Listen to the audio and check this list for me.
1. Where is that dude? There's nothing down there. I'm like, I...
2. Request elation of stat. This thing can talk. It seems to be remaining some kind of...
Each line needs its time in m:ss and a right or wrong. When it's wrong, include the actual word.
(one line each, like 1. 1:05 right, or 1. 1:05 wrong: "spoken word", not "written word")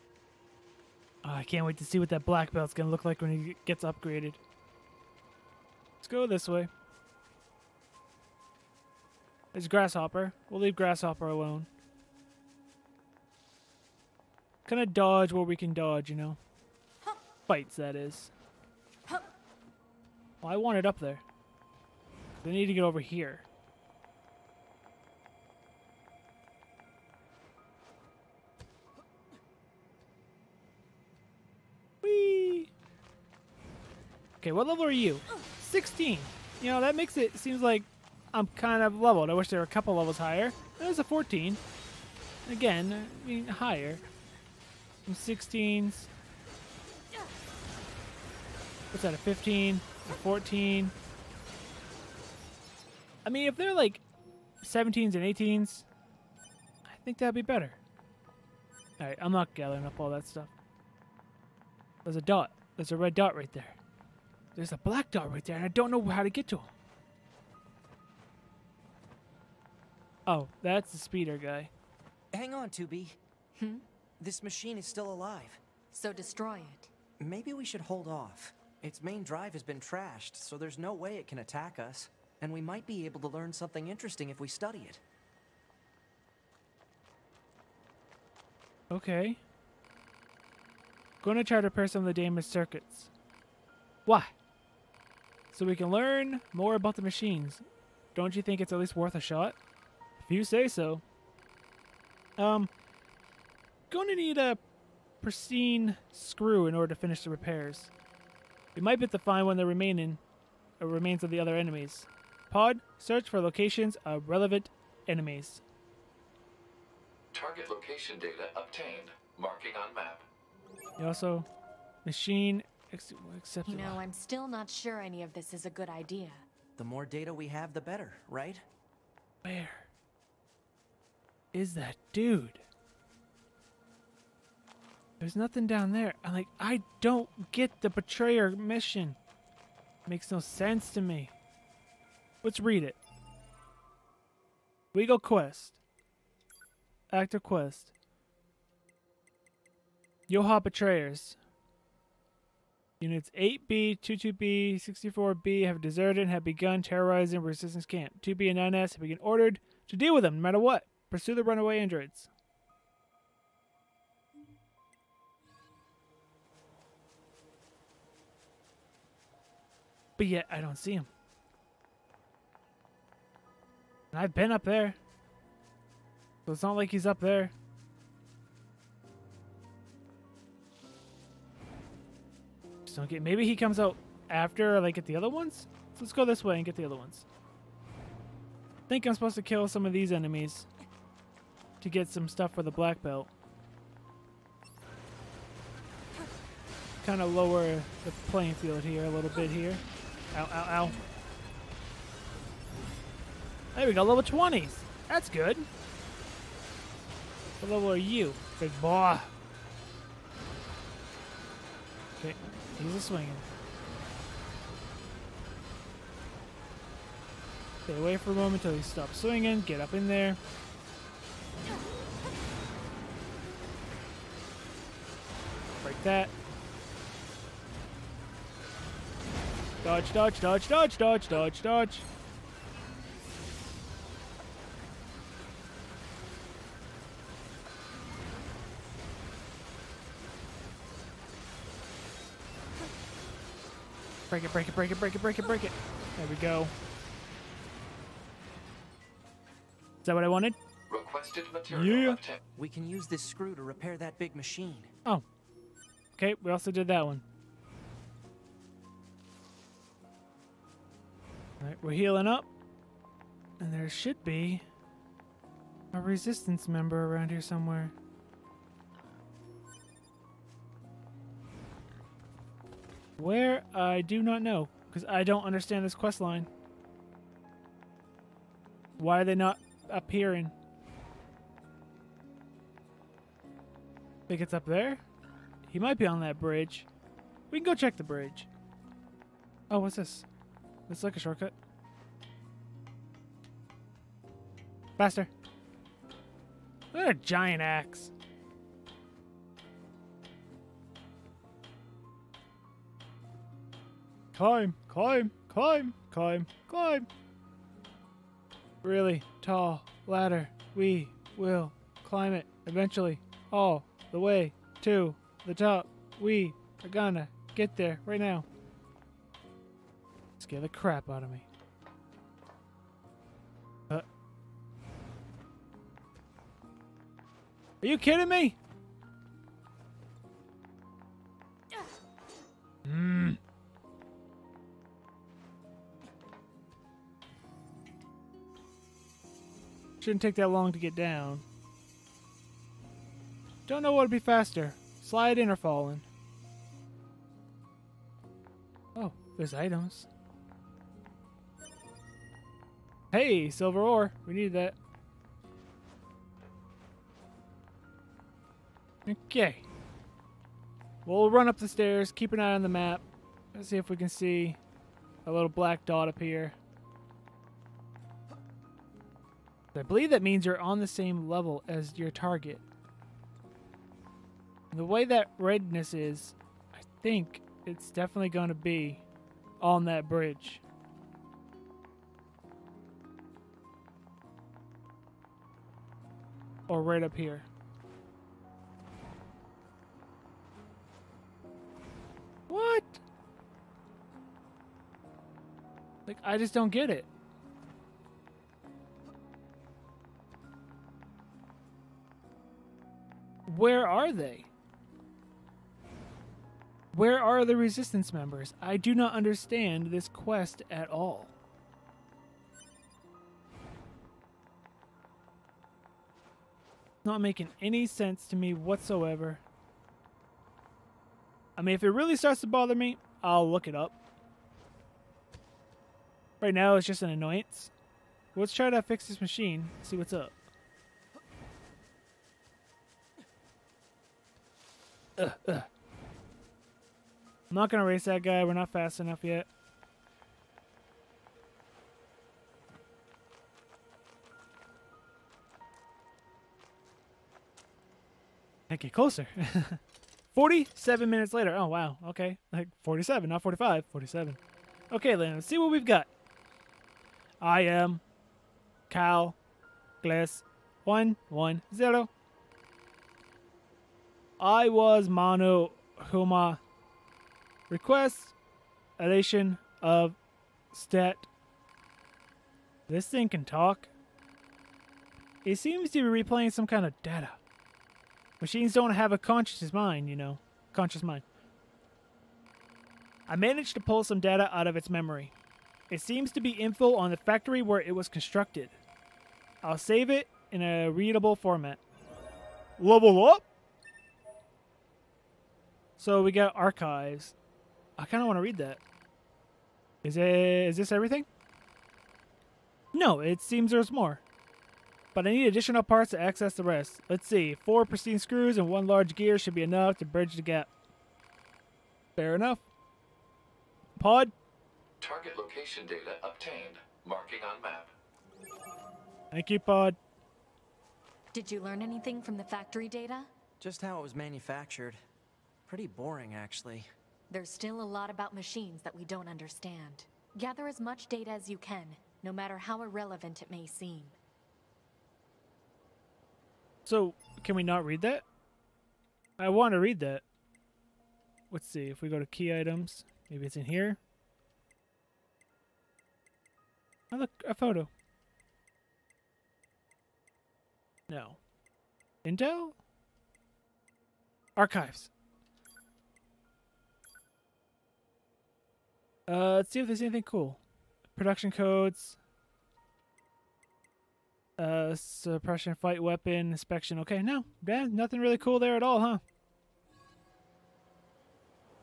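1. 2:09 right
2. 7:47 wrong: "replaying", not "remaining".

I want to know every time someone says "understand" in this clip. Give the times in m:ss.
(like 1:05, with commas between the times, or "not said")
4:35, 6:49, 8:49.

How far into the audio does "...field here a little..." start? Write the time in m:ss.
3:18.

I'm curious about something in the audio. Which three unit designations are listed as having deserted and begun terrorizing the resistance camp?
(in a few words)
8B, 22B, 64B.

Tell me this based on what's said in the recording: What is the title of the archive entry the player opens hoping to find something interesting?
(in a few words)
Production codes.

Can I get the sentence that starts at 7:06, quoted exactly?
Right now, it's just an annoyance.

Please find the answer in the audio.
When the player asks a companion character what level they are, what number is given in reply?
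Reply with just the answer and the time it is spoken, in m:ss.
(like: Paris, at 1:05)
16, at 0:35.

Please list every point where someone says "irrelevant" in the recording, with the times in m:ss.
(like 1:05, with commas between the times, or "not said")
8:52.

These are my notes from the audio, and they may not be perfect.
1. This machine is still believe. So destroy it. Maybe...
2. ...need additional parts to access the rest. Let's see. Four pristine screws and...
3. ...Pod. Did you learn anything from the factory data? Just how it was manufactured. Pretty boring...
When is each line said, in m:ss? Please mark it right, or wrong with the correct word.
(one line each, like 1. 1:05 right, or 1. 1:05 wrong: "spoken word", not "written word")
1. 1:14 wrong: "alive", not "believe"
2. 8:25 right
3. 8:39 right.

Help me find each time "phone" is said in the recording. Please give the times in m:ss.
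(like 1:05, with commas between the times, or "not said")
not said.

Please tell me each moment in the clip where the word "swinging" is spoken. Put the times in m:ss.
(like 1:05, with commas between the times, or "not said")
3:33, 3:39.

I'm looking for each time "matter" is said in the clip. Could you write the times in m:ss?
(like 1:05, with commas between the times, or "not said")
2:40, 8:52.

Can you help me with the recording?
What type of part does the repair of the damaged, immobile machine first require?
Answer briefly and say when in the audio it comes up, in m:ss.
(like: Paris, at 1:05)
pristine screw, at 1:45.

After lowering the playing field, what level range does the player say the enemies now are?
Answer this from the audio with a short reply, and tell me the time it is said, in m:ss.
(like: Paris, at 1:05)
level 20s, at 3:24.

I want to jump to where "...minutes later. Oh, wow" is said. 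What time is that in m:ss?
7:31.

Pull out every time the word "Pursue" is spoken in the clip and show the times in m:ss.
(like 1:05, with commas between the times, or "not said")
2:41.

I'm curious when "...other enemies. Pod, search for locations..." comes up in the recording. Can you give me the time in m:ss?
1:51.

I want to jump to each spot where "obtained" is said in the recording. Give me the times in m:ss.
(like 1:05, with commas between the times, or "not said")
1:58, 8:36.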